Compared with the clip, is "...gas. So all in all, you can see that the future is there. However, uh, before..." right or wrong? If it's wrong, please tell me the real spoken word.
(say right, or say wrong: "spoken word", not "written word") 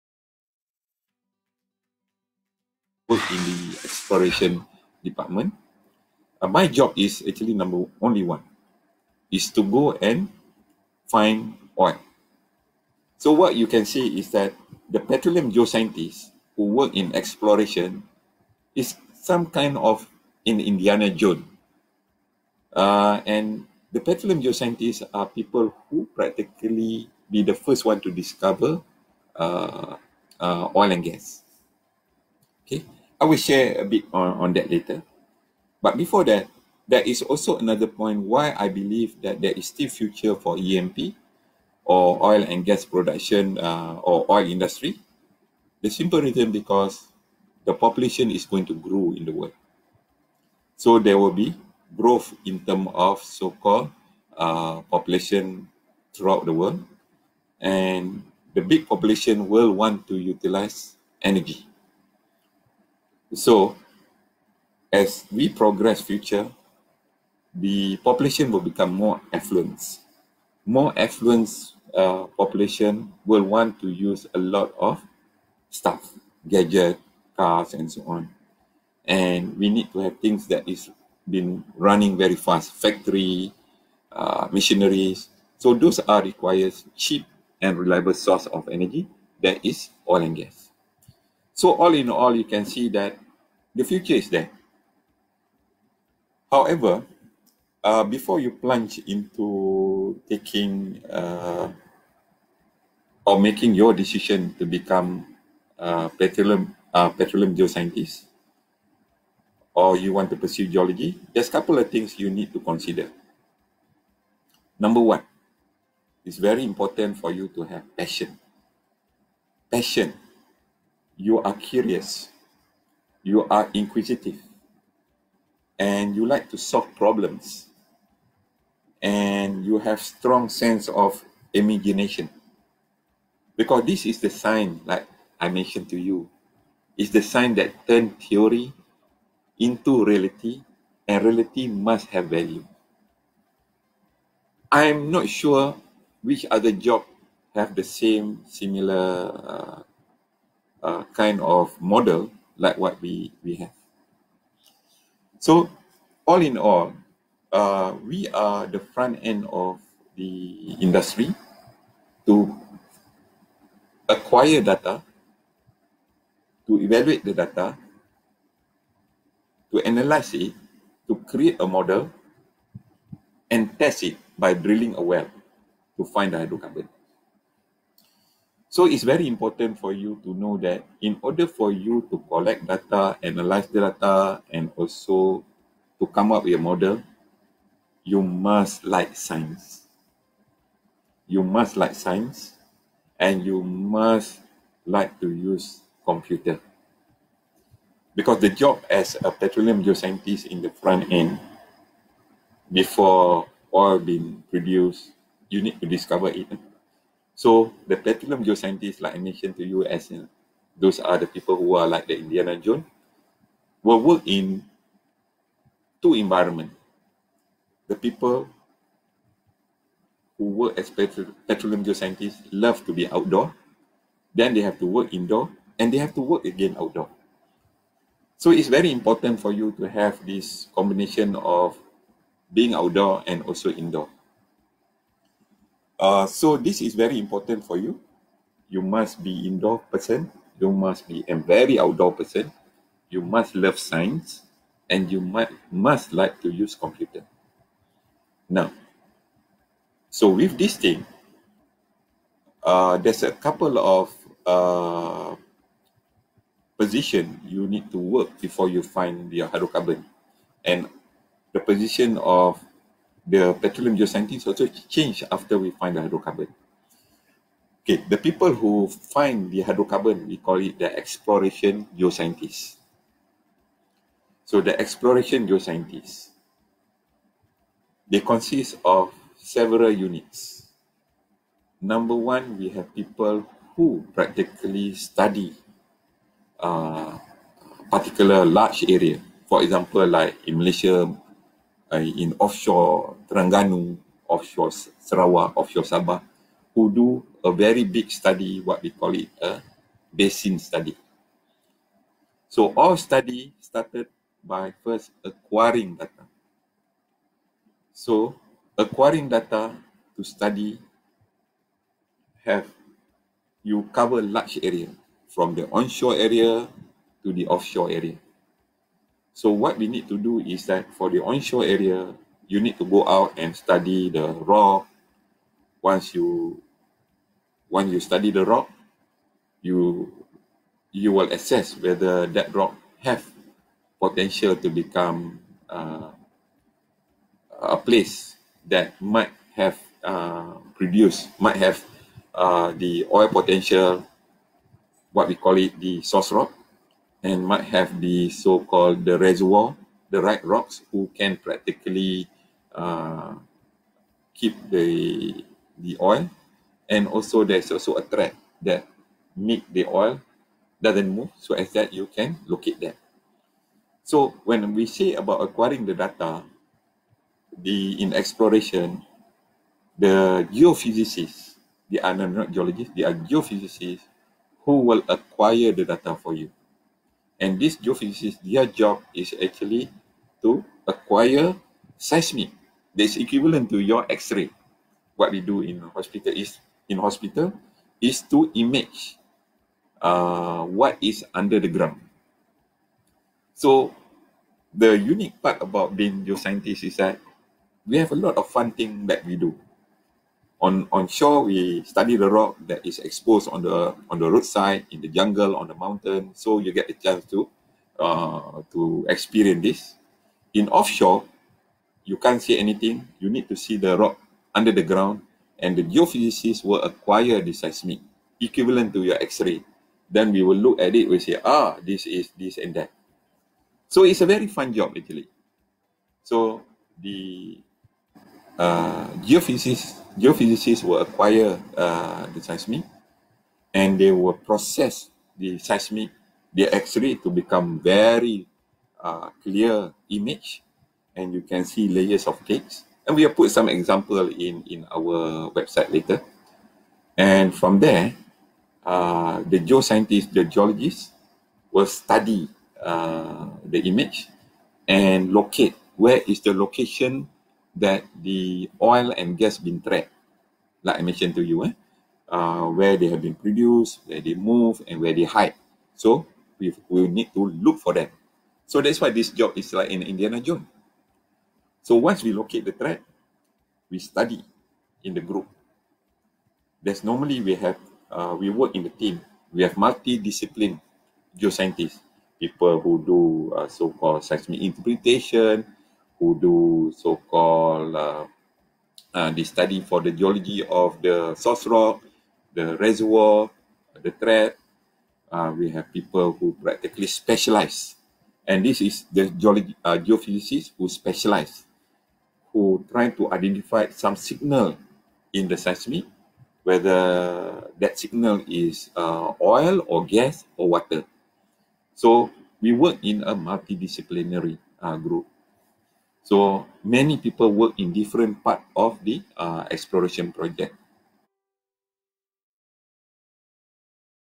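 right.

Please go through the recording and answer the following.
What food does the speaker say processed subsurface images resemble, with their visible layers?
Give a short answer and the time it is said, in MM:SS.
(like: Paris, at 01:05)
cakes, at 07:21.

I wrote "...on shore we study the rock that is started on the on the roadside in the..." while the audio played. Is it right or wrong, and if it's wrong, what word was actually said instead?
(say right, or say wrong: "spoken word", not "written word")
wrong: "exposed", not "started".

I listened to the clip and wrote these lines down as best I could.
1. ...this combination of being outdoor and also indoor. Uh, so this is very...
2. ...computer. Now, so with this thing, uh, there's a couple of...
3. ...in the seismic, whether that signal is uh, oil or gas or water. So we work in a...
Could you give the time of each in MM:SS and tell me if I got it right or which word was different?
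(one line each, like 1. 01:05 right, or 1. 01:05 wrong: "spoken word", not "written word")
1. 03:50 right
2. 04:06 right
3. 08:25 right.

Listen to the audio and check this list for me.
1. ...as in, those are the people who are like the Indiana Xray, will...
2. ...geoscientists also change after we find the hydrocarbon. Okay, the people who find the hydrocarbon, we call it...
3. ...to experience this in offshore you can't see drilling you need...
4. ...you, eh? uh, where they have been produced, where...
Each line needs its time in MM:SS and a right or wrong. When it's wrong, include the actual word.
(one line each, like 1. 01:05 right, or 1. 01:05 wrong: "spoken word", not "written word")
1. 03:29 wrong: "Jones", not "Xray"
2. 04:23 right
3. 06:48 wrong: "anything", not "drilling"
4. 07:41 right.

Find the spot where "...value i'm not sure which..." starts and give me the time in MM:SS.
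02:22.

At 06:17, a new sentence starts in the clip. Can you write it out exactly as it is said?
And these geophysicists, their job is actually to acquire seismic that's equivalent to your X-ray.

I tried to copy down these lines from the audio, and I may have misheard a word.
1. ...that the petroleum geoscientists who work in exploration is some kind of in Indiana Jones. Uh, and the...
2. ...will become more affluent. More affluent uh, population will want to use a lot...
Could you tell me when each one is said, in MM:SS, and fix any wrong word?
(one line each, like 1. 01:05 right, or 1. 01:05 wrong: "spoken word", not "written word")
1. 00:14 right
2. 01:08 right.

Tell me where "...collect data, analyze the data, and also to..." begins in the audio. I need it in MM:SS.
03:02.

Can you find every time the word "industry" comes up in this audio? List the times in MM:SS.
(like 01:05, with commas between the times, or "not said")
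00:44, 02:40.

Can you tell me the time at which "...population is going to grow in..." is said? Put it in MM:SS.
00:47.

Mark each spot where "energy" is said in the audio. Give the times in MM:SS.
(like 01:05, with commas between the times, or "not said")
01:01, 01:28.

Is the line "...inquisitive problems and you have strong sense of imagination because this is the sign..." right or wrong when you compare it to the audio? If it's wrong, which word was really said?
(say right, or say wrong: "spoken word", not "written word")
wrong: "solve", not "inquisitive".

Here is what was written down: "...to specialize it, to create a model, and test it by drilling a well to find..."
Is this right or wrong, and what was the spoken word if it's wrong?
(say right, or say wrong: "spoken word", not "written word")
wrong: "analyze", not "specialize".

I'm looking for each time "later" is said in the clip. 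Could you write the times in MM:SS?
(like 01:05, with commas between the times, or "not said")
00:34, 07:25.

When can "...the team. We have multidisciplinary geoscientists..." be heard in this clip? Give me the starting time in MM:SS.
07:58.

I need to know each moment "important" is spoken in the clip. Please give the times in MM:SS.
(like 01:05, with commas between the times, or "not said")
01:56, 02:59, 03:48, 03:57.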